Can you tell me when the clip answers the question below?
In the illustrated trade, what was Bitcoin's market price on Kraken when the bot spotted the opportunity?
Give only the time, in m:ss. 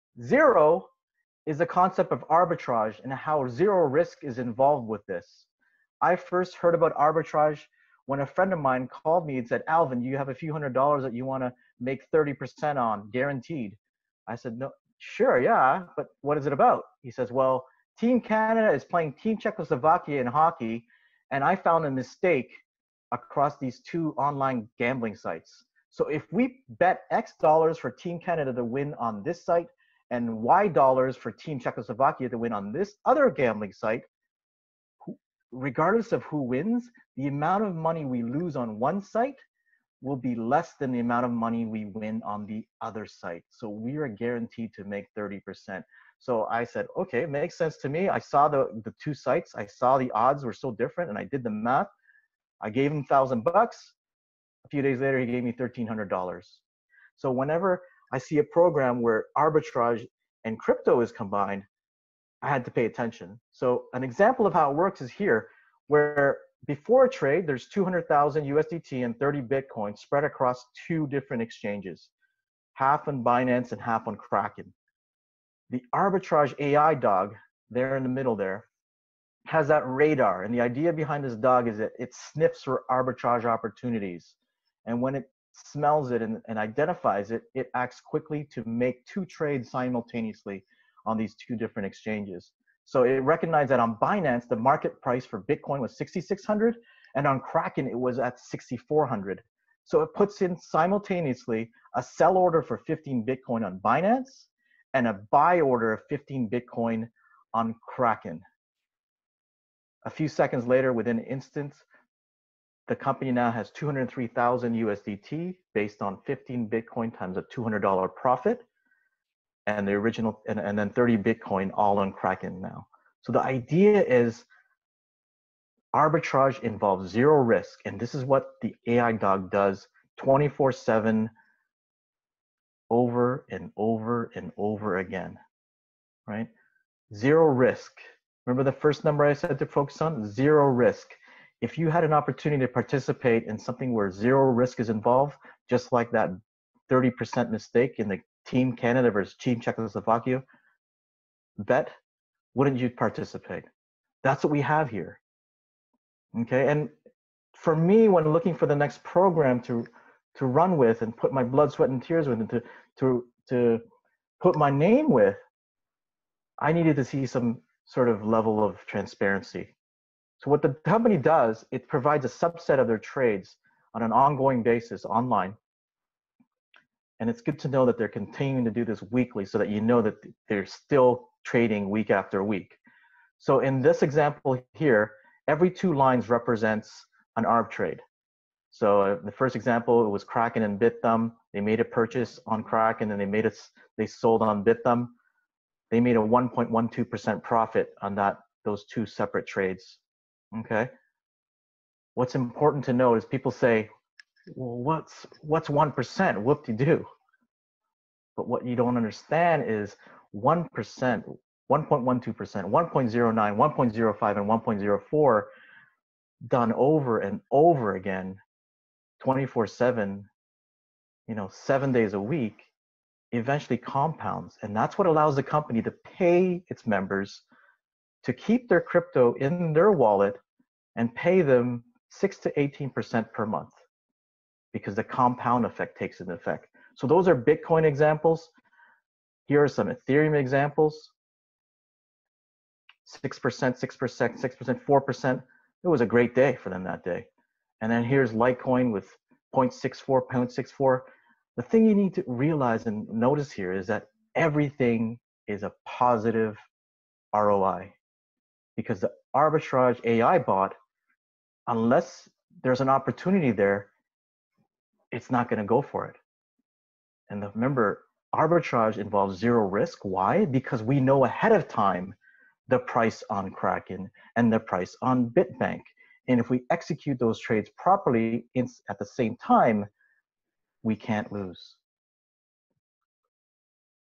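1:38.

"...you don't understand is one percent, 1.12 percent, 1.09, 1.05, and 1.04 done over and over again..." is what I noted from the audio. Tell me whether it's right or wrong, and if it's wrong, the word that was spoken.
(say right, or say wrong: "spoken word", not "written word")
right.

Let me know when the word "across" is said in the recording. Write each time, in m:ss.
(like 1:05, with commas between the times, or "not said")
0:23, 1:10.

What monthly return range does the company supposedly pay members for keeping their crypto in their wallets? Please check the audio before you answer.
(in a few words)
6 to 18%.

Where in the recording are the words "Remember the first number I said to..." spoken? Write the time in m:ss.
2:18.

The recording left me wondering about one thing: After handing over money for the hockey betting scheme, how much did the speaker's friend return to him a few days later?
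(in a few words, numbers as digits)
$1300.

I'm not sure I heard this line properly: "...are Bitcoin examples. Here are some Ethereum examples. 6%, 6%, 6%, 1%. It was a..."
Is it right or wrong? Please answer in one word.
wrong.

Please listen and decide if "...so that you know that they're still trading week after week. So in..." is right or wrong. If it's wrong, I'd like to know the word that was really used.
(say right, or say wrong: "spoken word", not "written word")
right.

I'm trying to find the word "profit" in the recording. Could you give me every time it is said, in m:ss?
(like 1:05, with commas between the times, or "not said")
1:58, 3:17.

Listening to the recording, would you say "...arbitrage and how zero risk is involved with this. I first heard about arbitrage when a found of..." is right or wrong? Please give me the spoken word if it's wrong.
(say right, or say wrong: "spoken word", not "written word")
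wrong: "friend", not "found".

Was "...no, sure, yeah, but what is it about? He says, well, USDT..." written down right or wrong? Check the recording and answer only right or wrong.
wrong.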